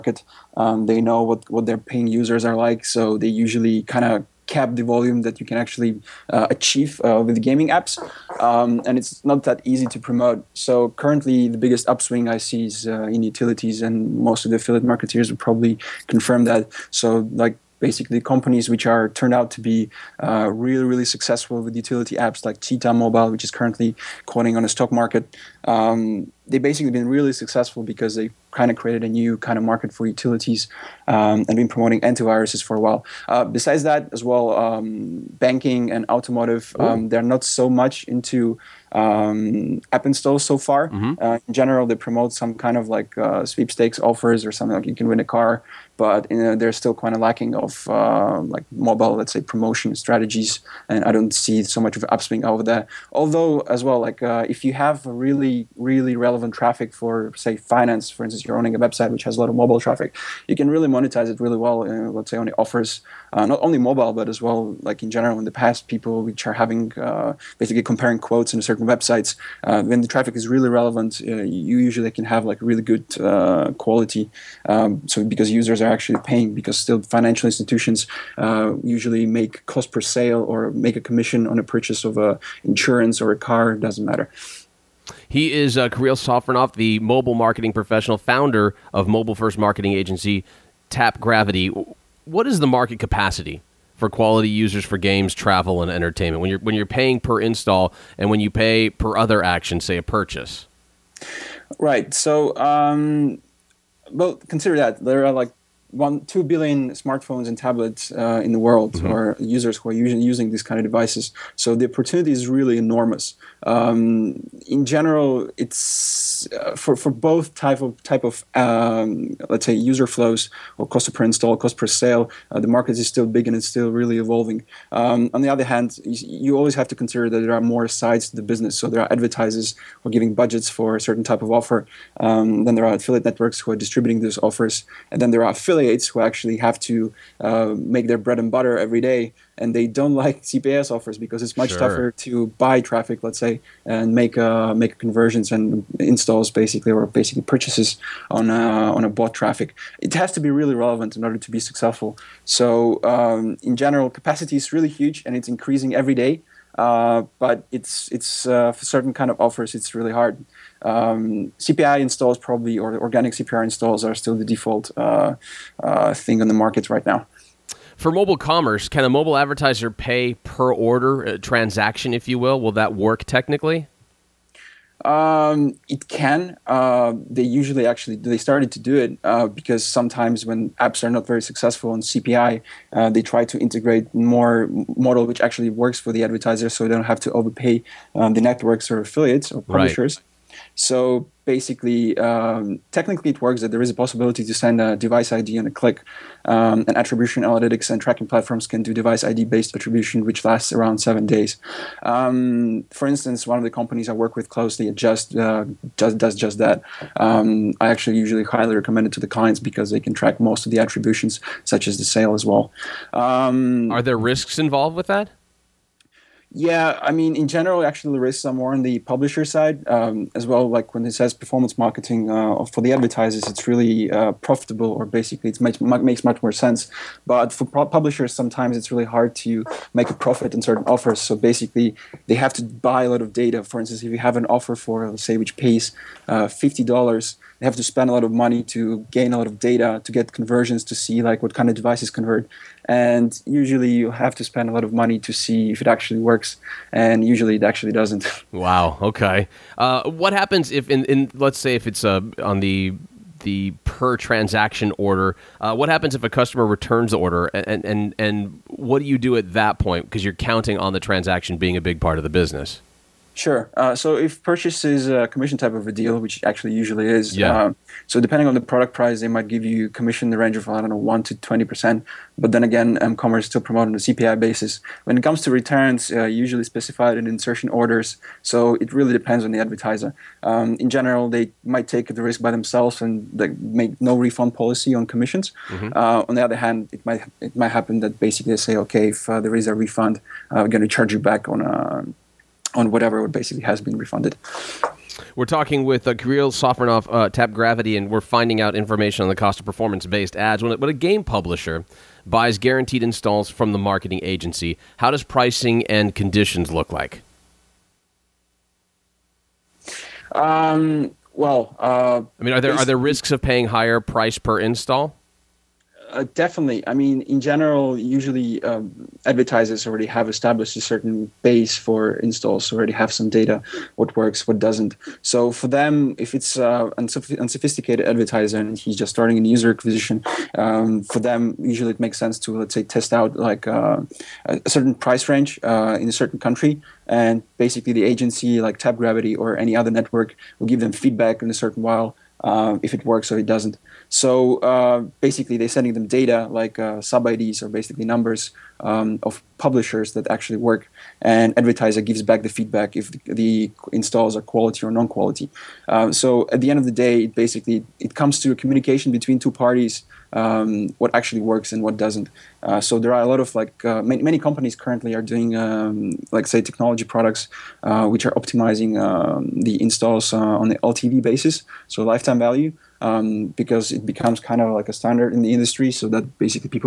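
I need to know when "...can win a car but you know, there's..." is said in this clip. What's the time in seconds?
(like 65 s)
44 s.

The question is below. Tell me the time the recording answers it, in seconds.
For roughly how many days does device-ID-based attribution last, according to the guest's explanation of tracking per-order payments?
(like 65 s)
200 s.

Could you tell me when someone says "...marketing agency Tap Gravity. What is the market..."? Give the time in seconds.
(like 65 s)
89 s.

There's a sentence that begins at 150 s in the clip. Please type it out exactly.
It has to be really relevant in order to be successful.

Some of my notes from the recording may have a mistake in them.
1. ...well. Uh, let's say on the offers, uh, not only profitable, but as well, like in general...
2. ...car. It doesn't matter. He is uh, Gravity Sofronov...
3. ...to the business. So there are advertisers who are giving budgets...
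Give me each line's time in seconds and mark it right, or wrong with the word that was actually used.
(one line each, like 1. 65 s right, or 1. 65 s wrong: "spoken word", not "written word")
1. 61 s wrong: "mobile", not "profitable"
2. 83 s wrong: "Kirill", not "Gravity"
3. 128 s right.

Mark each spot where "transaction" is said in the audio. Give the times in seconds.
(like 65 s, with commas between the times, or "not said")
171 s, 254 s, 261 s.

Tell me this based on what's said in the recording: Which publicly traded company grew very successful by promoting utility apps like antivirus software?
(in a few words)
Cheetah Mobile.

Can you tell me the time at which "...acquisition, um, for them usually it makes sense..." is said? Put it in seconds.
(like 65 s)
329 s.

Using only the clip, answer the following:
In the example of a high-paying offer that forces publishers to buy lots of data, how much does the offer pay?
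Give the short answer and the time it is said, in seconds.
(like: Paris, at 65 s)
$50, at 236 s.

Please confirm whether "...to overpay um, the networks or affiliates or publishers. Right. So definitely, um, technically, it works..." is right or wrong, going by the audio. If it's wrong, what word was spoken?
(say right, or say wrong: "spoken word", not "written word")
wrong: "basically", not "definitely".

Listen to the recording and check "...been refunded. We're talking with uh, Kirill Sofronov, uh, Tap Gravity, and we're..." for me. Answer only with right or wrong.
right.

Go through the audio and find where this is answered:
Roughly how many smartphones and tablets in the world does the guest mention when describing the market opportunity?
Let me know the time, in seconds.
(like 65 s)
105 s.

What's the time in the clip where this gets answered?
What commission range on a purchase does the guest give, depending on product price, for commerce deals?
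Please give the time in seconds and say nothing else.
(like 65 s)
270 s.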